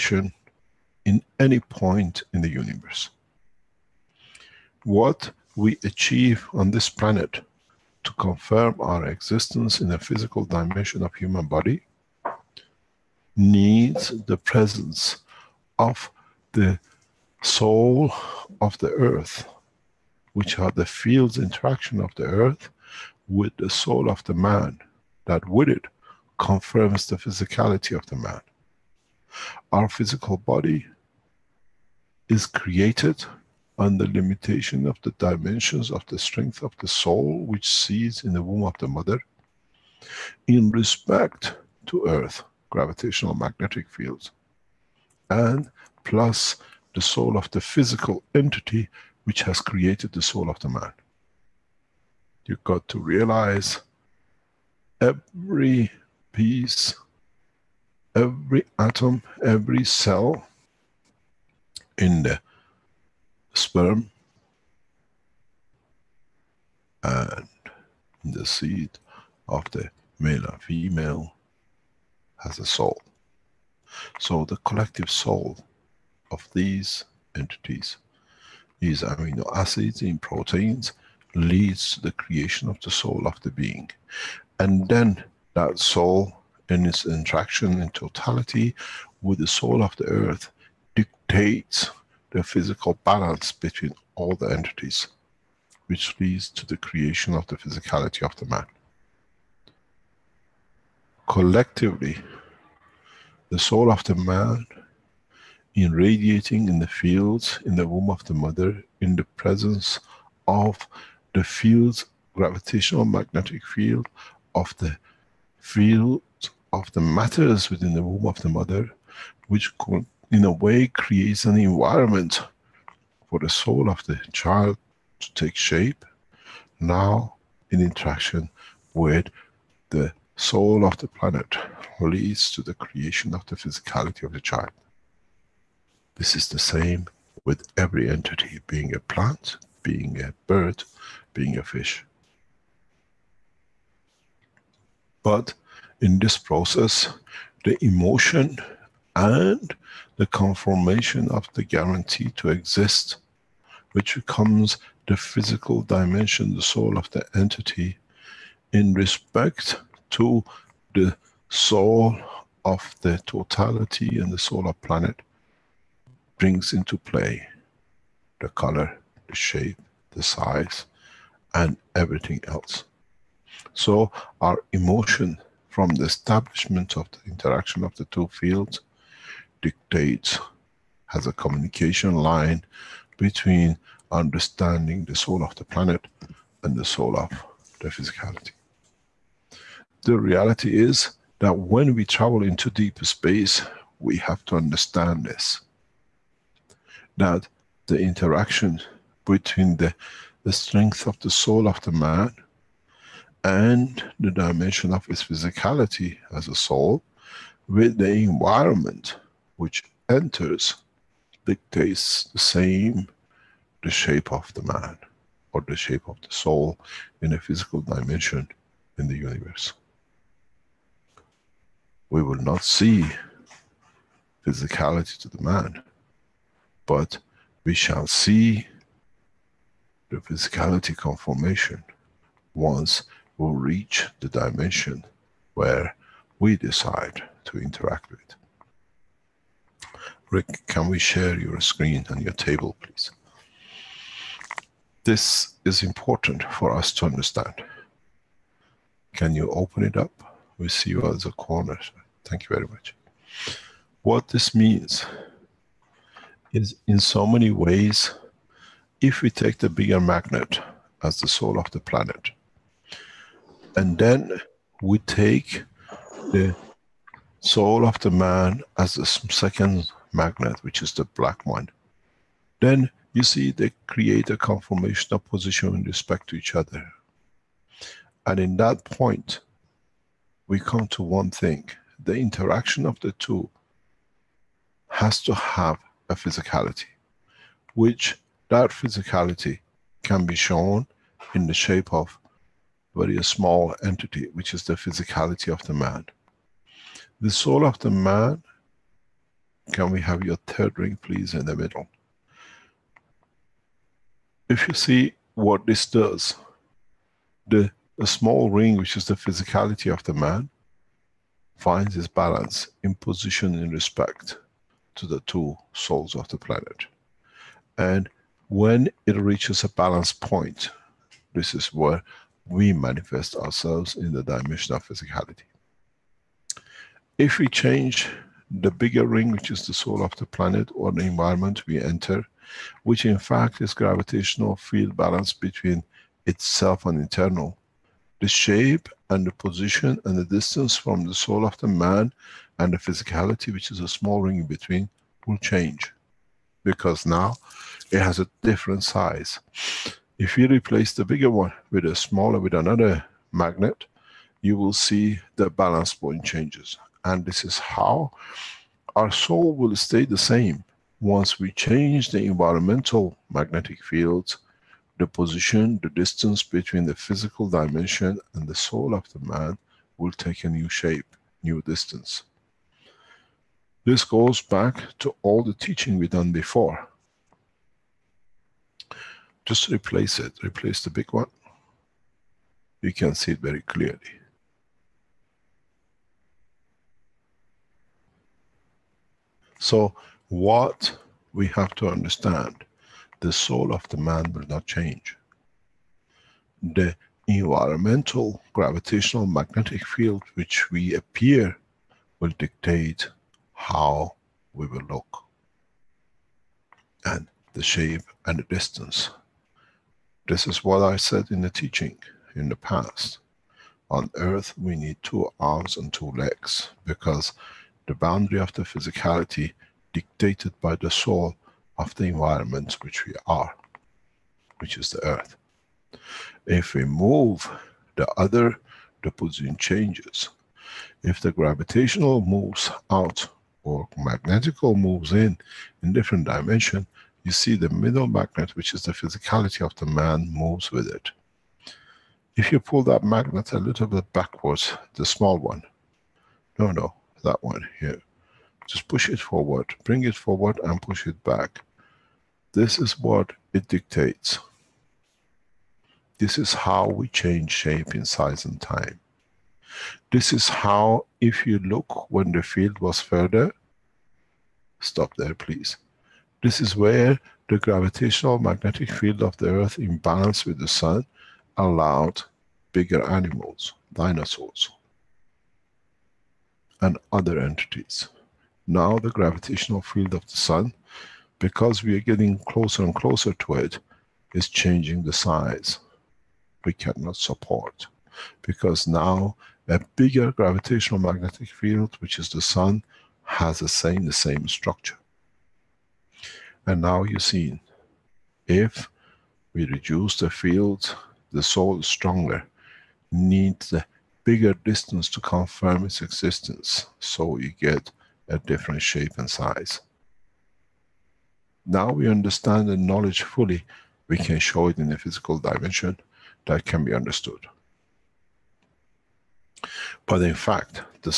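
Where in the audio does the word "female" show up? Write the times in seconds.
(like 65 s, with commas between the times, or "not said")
70 s.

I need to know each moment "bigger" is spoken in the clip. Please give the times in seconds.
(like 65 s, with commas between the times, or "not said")
259 s, 328 s, 351 s, 472 s, 489 s, 504 s.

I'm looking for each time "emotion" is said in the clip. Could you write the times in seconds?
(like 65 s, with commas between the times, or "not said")
147 s, 174 s.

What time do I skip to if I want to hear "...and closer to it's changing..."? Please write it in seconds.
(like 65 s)
482 s.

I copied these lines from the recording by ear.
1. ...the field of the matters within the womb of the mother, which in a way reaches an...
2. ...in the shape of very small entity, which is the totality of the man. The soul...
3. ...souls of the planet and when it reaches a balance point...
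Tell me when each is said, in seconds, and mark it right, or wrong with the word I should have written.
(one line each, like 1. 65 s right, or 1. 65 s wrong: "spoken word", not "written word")
1. 114 s wrong: "creates", not "reaches"
2. 291 s wrong: "physicality", not "totality"
3. 315 s right.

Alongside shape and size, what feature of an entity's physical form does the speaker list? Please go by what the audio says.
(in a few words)
the color.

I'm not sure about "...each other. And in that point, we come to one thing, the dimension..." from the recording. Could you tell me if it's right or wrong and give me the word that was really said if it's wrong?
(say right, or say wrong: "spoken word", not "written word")
wrong: "interaction", not "dimension".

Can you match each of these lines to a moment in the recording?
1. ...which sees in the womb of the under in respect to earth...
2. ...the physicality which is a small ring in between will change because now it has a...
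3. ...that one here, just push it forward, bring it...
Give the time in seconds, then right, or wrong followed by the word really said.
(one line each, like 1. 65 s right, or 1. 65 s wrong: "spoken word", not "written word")
1. 37 s wrong: "mother", not "under"
2. 342 s right
3. 447 s right.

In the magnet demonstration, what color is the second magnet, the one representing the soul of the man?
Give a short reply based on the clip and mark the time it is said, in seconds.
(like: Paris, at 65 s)
black, at 271 s.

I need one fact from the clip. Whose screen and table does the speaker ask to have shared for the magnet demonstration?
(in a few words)
Rick.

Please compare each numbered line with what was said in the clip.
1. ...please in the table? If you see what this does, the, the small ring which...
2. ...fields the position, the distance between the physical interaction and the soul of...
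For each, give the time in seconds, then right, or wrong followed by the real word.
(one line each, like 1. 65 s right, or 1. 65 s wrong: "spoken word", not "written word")
1. 301 s wrong: "middle", not "table"
2. 363 s wrong: "dimension", not "interaction".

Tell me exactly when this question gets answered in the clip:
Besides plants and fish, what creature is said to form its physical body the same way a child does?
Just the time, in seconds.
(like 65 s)
139 s.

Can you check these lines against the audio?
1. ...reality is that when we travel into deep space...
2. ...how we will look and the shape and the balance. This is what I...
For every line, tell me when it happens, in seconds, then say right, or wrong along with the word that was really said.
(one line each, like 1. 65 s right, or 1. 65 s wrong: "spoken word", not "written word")
1. 190 s right
2. 403 s wrong: "distance", not "balance".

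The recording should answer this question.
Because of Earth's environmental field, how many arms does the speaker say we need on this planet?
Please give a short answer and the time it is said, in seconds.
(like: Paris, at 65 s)
2, at 415 s.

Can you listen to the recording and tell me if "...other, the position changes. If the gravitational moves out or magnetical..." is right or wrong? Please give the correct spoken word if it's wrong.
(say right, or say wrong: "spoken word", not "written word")
right.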